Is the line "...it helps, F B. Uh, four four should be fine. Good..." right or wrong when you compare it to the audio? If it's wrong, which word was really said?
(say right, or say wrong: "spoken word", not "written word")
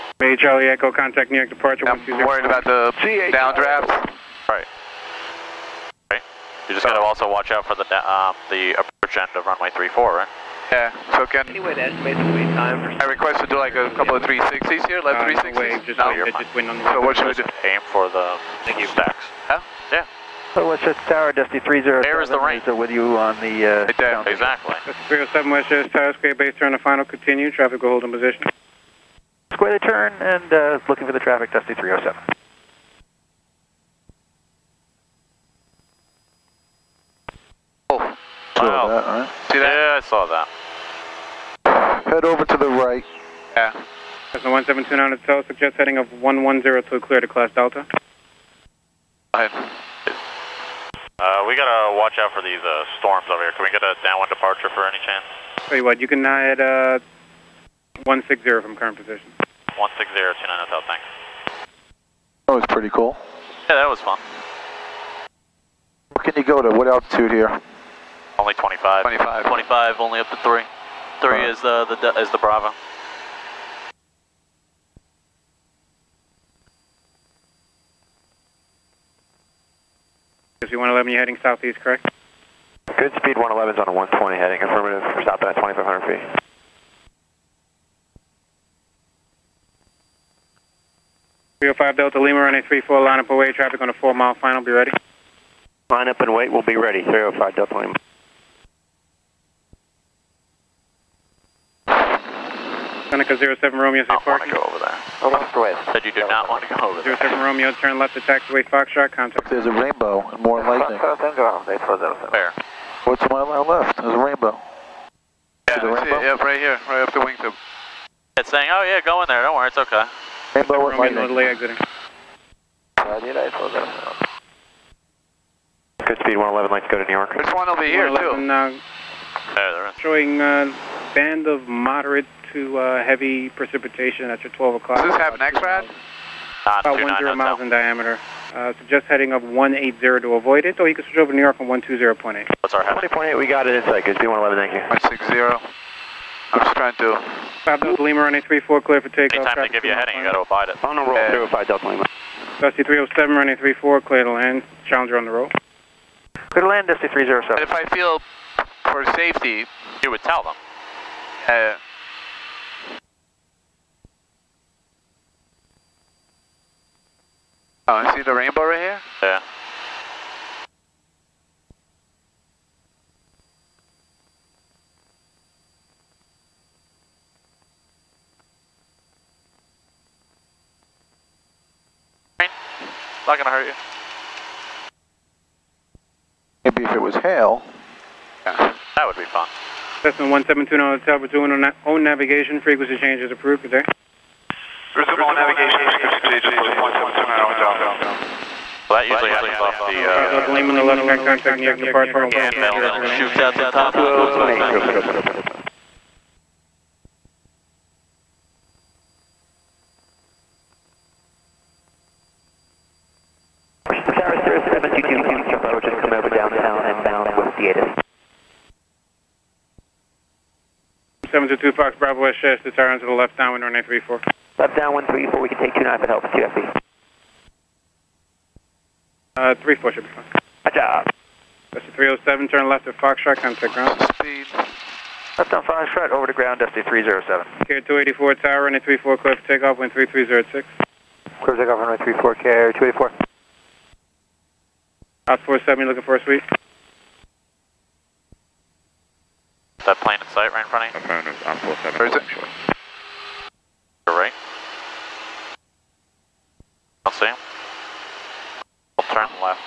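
wrong: "three", not "four".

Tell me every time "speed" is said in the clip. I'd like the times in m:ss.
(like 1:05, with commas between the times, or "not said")
1:23, 2:06, 3:54.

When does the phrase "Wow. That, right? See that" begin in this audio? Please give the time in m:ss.
0:38.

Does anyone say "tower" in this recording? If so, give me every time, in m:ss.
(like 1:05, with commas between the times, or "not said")
0:21, 0:25, 3:34, 3:42, 3:58.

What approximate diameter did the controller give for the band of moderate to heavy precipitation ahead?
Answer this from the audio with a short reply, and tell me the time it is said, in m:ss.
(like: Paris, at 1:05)
About 10 miles, at 2:16.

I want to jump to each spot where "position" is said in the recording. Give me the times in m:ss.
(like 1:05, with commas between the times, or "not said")
0:28, 0:58.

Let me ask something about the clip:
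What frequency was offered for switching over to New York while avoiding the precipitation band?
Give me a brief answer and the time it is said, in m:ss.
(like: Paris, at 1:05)
120.8, at 2:21.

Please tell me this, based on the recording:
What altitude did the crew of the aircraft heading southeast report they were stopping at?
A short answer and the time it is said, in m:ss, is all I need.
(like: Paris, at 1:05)
2,500 feet, at 1:25.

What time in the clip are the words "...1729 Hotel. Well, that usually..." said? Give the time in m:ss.
3:16.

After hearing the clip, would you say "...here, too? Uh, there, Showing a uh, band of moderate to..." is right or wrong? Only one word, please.
right.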